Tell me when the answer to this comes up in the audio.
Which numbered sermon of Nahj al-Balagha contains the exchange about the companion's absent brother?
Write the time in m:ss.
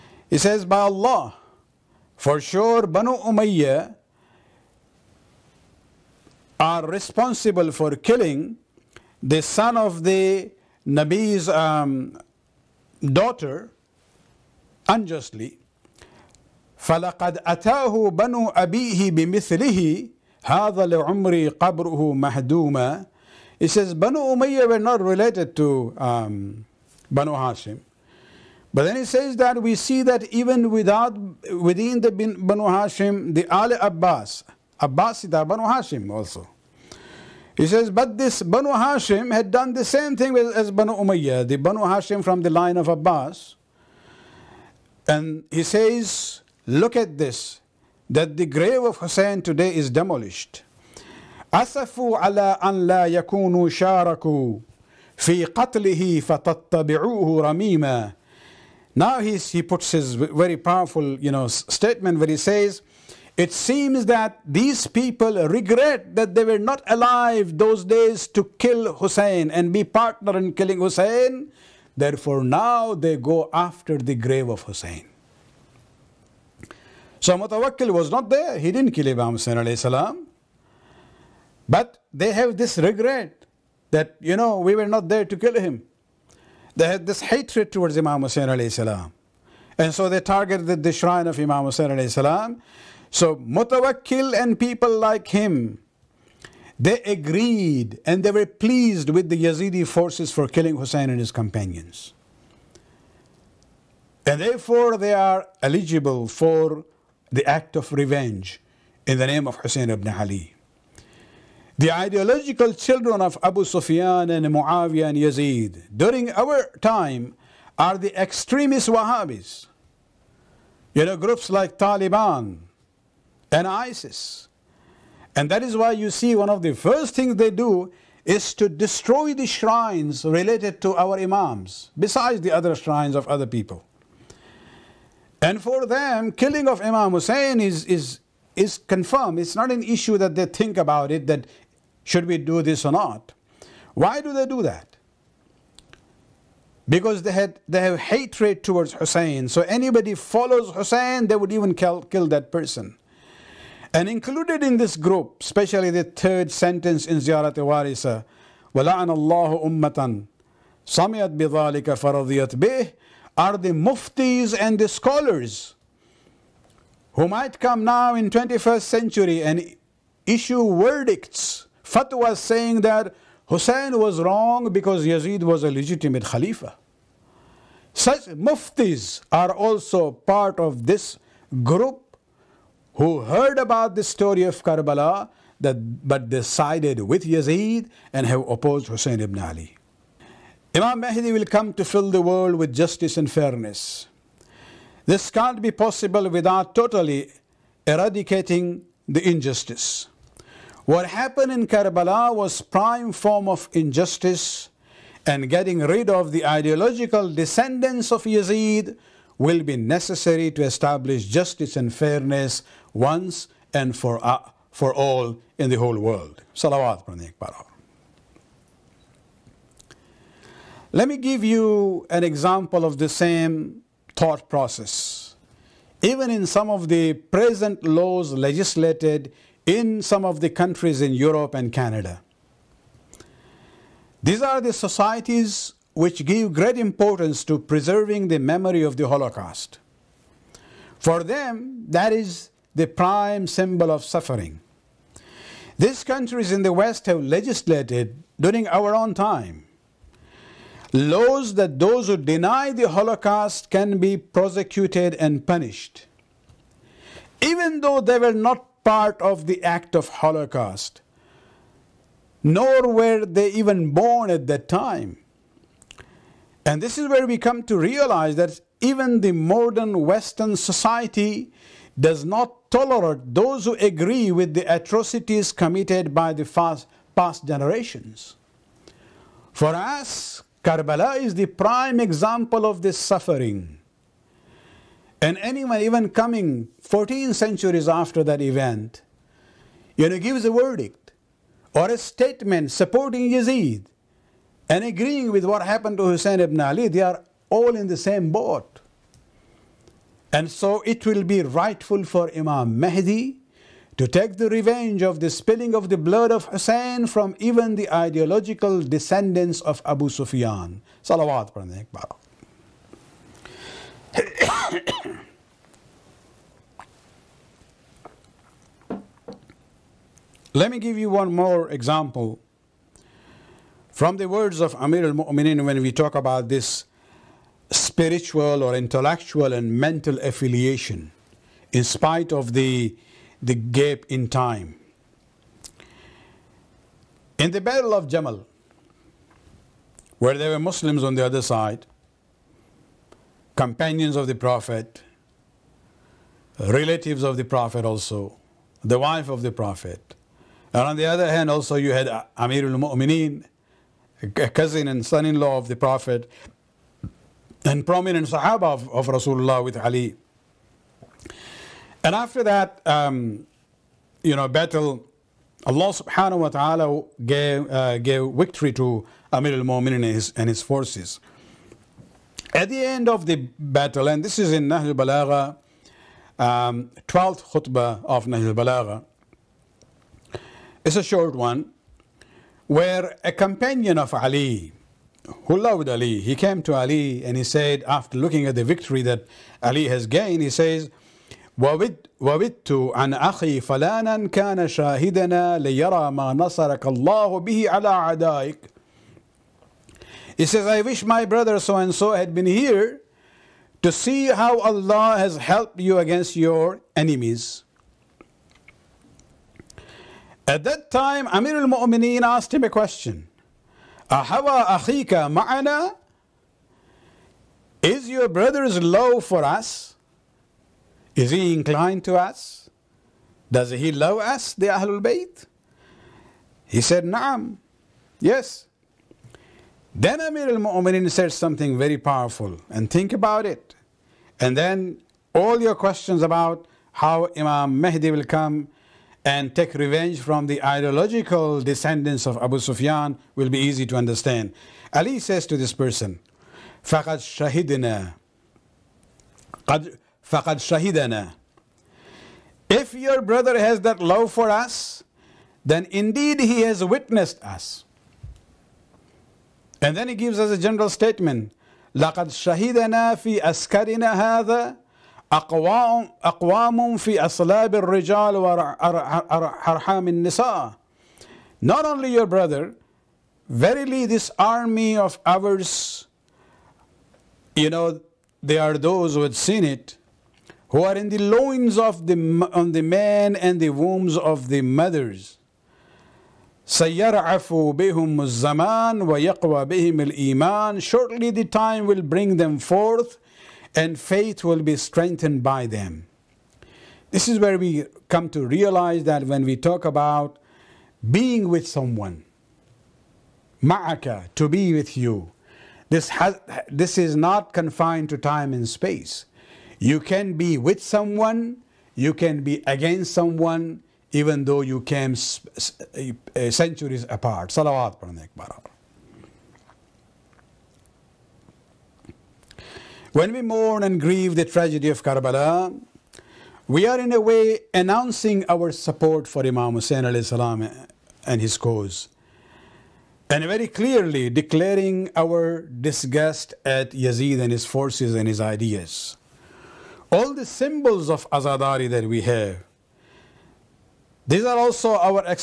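6:17.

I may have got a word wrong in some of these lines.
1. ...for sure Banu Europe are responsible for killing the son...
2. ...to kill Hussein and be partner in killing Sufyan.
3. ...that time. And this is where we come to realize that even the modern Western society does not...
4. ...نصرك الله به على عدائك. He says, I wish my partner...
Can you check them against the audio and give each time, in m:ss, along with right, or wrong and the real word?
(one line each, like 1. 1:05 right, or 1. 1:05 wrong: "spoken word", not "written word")
1. 0:02 wrong: "Umayya", not "Europe"
2. 1:08 wrong: "Hussein", not "Sufyan"
3. 4:24 right
4. 6:36 wrong: "brother", not "partner".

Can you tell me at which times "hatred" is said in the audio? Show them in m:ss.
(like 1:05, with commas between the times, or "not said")
1:27, 2:27.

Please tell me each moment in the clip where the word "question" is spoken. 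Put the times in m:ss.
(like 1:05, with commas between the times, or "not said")
6:52, 7:15.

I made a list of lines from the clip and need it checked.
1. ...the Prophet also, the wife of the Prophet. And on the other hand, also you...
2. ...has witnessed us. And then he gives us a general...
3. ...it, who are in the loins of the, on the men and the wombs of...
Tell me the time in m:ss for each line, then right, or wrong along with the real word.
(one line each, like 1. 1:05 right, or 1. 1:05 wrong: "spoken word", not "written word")
1. 5:47 right
2. 7:36 right
3. 7:59 right.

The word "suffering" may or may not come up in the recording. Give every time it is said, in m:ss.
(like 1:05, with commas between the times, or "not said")
4:04, 4:42.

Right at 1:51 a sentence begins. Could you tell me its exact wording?
The ideological children of Abu Sufyan and Muawiyah and Yazid during our time are the extremist Wahhabis.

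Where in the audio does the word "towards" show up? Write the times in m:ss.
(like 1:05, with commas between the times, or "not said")
1:27, 2:28.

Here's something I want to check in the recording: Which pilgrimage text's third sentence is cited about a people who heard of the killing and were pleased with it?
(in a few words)
Ziyarat Warith.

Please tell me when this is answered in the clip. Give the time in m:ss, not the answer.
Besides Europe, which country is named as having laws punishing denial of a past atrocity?
3:51.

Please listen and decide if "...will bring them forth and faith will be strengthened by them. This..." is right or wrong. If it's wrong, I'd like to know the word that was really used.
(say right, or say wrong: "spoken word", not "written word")
right.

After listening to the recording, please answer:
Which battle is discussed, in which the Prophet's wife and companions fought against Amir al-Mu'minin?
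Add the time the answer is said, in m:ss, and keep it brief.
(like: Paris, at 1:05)
Battle of Jamal, at 5:37.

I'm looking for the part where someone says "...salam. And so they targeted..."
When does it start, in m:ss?
1:28.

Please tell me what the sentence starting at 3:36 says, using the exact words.
Salawat Let me give you an example of the same thought process.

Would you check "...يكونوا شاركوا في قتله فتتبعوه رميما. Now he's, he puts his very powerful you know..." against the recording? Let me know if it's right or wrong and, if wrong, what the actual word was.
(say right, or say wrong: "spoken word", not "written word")
right.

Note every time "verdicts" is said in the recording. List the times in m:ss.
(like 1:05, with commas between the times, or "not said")
2:50, 4:50.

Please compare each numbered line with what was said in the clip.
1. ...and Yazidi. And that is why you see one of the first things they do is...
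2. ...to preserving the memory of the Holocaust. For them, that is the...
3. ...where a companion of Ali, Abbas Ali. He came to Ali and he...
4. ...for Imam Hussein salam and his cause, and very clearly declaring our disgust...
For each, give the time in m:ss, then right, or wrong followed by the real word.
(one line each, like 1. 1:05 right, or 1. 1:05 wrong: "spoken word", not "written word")
1. 2:03 wrong: "ISIS", not "Yazidi"
2. 3:57 right
3. 6:22 wrong: "Hullah", not "Abbas"
4. 8:49 right.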